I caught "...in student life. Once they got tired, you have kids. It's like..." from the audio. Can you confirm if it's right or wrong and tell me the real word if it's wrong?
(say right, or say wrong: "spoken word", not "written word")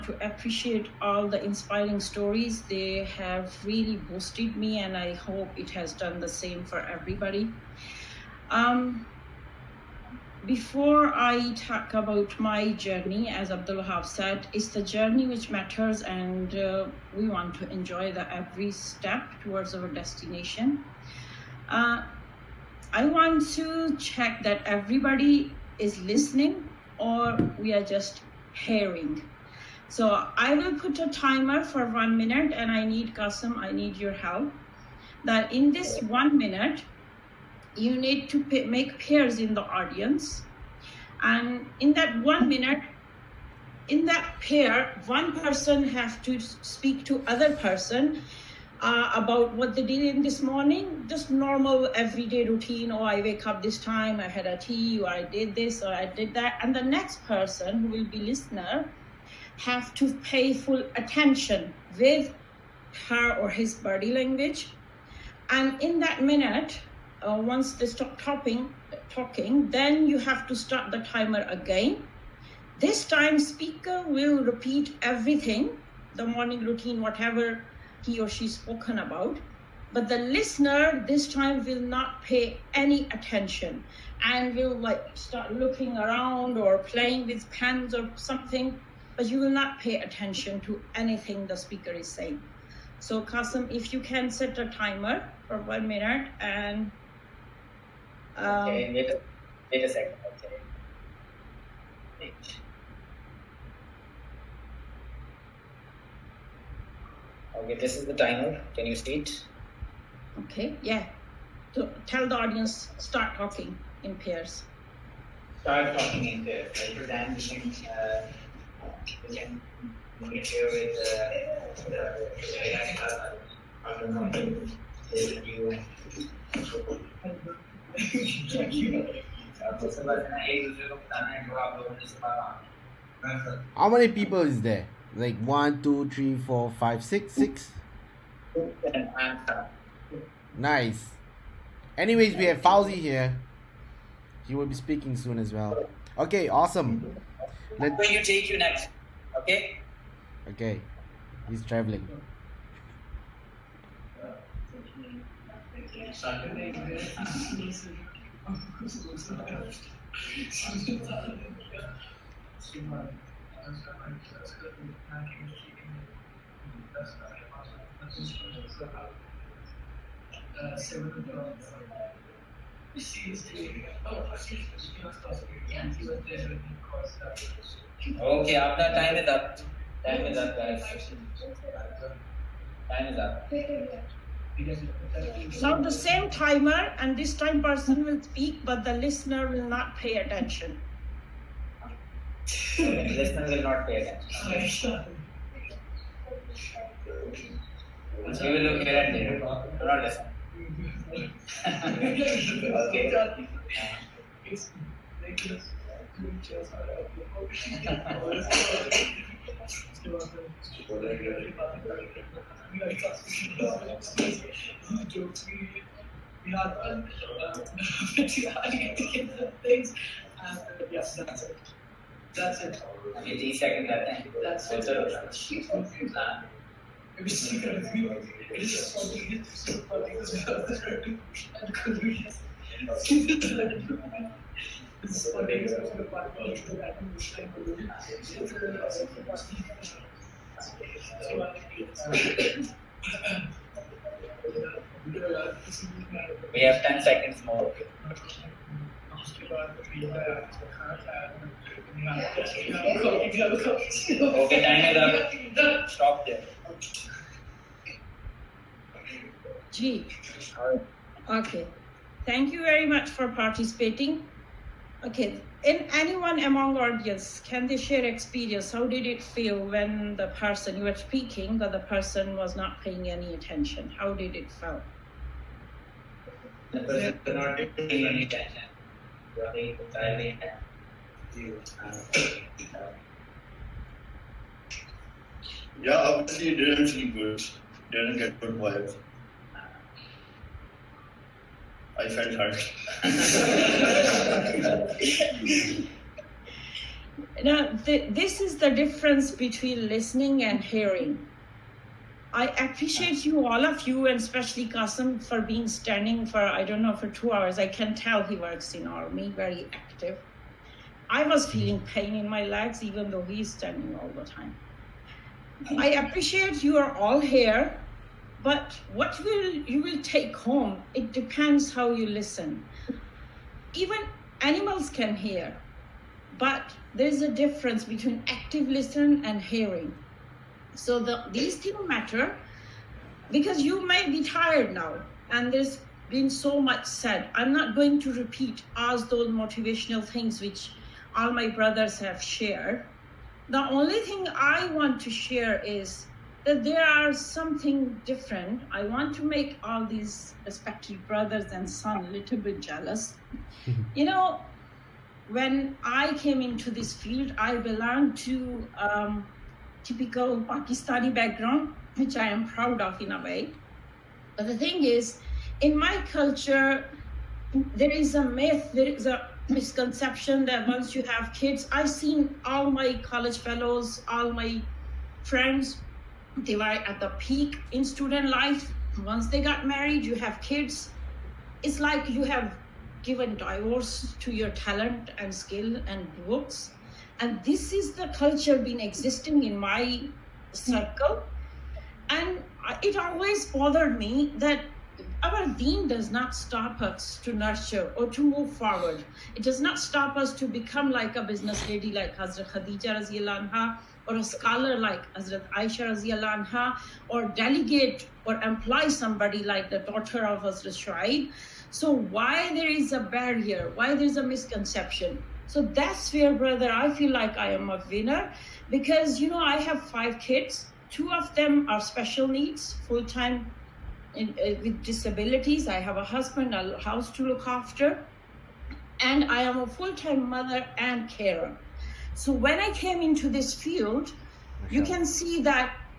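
wrong: "married", not "tired".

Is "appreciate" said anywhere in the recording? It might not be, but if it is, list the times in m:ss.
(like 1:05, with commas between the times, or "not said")
0:00, 5:02, 5:16.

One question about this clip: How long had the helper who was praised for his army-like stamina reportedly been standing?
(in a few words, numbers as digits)
Two hours.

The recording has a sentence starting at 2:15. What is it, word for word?
Like one, two, three, four, five, six, six.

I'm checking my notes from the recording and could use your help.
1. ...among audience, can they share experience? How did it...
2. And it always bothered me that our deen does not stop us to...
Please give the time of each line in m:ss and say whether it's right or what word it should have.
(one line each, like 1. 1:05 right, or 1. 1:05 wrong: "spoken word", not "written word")
1. 4:26 right
2. 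6:32 right.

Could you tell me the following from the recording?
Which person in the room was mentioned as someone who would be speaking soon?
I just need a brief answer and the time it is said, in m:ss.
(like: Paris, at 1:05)
Fauzi, at 2:22.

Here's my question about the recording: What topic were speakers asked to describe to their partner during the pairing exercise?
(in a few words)
Morning routine.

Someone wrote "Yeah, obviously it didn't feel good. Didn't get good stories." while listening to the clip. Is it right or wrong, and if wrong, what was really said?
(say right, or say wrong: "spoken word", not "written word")
wrong: "vibes", not "stories".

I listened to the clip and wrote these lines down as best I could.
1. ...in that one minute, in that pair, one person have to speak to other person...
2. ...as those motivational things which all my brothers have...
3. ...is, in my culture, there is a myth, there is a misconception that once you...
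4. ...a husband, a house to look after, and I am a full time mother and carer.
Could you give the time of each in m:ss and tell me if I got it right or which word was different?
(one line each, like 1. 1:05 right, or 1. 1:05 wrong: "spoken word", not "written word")
1. 0:41 right
2. 5:38 right
3. 6:04 right
4. 7:05 right.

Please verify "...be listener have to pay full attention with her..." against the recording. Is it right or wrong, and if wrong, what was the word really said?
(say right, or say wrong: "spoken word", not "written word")
right.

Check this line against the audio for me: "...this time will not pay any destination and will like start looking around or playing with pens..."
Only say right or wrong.
wrong.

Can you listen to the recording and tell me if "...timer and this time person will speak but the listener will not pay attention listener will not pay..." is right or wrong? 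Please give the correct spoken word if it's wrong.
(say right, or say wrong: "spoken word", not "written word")
right.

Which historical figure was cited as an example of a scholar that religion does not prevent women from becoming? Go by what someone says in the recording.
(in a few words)
Hazrat Aisha.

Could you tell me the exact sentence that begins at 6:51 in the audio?
So why there is a barrier?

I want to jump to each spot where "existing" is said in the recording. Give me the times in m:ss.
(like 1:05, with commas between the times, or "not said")
6:28.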